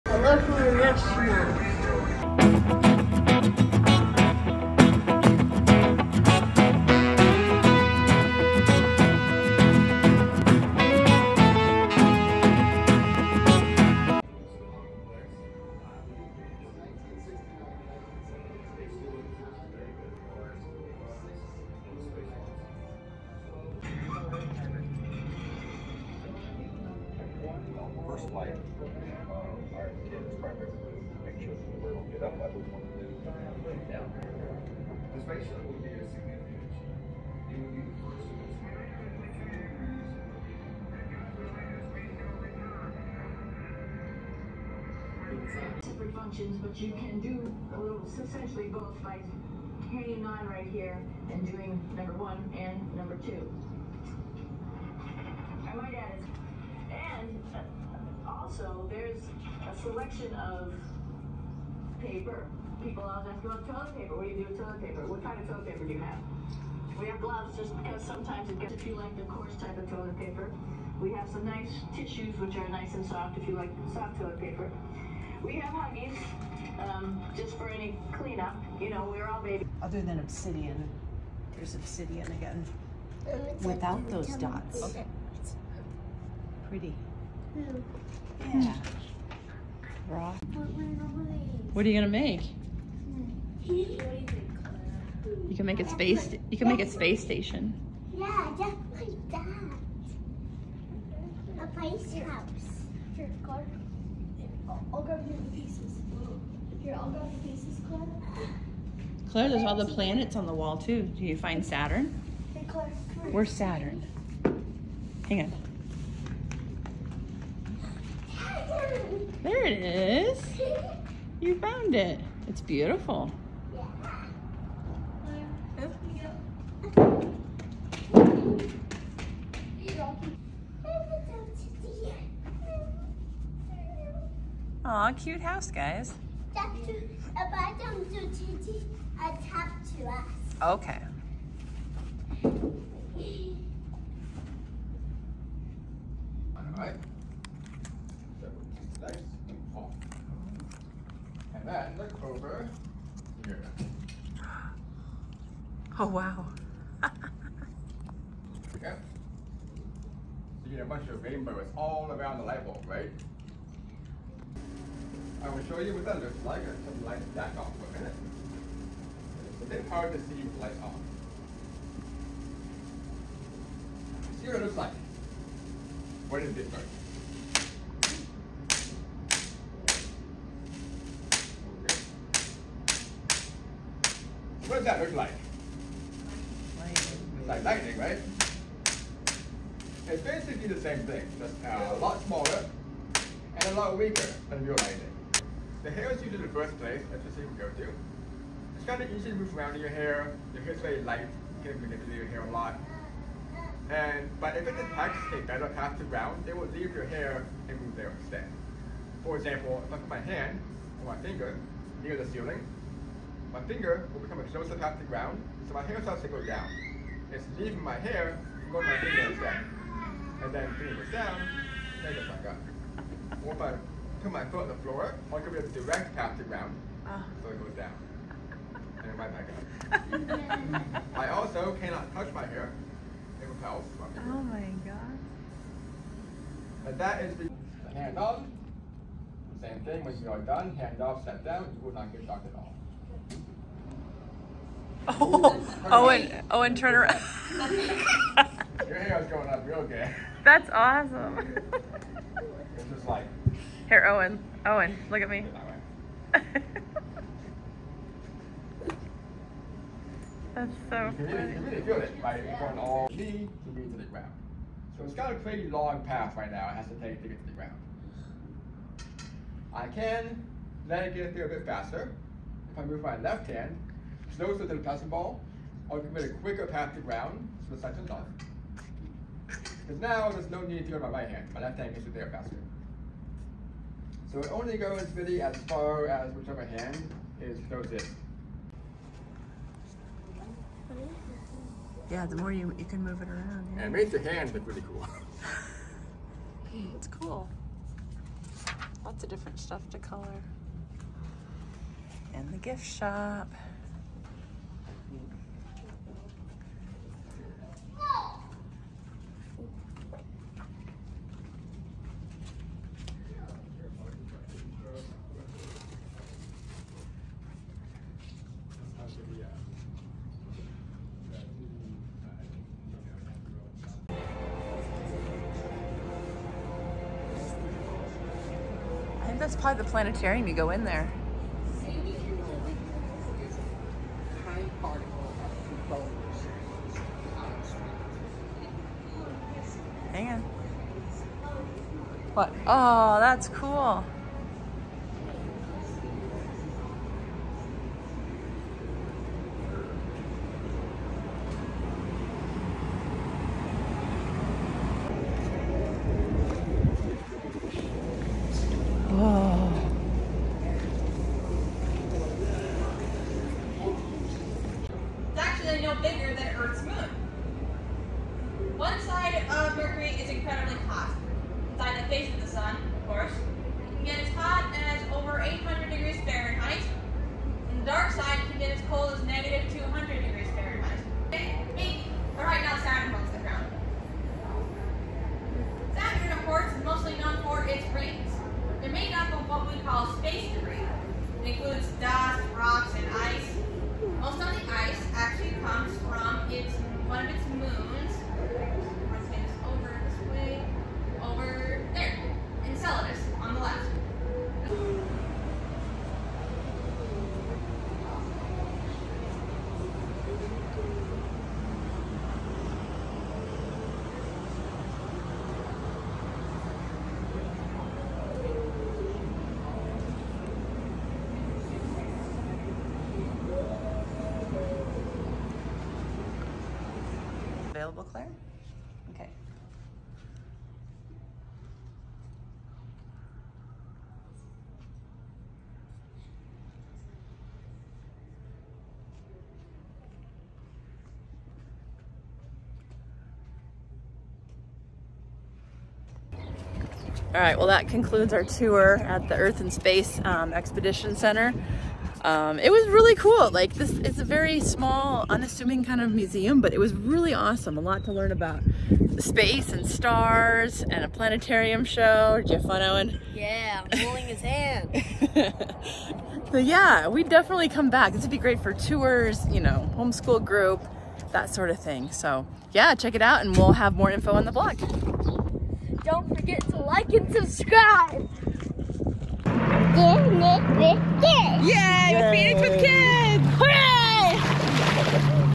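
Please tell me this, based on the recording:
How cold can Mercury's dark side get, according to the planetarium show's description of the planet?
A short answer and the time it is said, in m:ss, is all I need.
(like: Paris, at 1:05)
negative 200, at 6:19.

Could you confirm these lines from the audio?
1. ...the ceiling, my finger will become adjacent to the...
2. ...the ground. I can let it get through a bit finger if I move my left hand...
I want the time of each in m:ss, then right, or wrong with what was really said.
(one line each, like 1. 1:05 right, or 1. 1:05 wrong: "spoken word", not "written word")
1. 3:32 right
2. 4:27 wrong: "faster", not "finger".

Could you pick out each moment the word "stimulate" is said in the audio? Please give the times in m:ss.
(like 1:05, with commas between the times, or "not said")
not said.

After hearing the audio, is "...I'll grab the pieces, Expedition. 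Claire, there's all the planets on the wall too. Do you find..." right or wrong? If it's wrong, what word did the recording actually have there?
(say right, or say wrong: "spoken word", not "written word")
wrong: "Claire", not "Expedition".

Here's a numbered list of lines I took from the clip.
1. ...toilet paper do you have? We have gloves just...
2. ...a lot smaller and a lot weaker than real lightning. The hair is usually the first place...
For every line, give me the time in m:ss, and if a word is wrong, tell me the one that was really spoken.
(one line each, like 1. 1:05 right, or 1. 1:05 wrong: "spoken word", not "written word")
1. 1:05 right
2. 3:11 right.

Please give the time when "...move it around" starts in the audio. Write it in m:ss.
4:53.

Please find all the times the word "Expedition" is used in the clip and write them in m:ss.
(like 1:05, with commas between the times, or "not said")
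7:30.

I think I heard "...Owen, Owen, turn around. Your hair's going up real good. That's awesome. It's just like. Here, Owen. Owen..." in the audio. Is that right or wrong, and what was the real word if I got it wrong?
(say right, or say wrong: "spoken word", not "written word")
right.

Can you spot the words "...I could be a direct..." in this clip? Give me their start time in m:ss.
3:45.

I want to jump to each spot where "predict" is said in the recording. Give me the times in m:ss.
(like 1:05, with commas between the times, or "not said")
not said.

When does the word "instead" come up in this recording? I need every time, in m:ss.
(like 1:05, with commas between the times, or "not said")
3:28, 3:39.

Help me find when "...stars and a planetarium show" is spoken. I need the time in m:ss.
7:39.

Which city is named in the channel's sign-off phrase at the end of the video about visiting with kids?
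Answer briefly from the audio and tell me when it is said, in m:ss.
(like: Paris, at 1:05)
Phoenix, at 8:02.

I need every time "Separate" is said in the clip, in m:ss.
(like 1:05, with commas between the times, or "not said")
0:45.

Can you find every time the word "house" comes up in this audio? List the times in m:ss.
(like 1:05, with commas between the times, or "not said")
1:42, 2:15.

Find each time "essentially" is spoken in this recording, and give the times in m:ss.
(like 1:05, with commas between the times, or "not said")
0:48.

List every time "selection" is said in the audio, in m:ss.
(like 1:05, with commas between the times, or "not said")
0:59.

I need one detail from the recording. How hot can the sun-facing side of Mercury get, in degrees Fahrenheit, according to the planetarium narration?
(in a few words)
over 800 degrees.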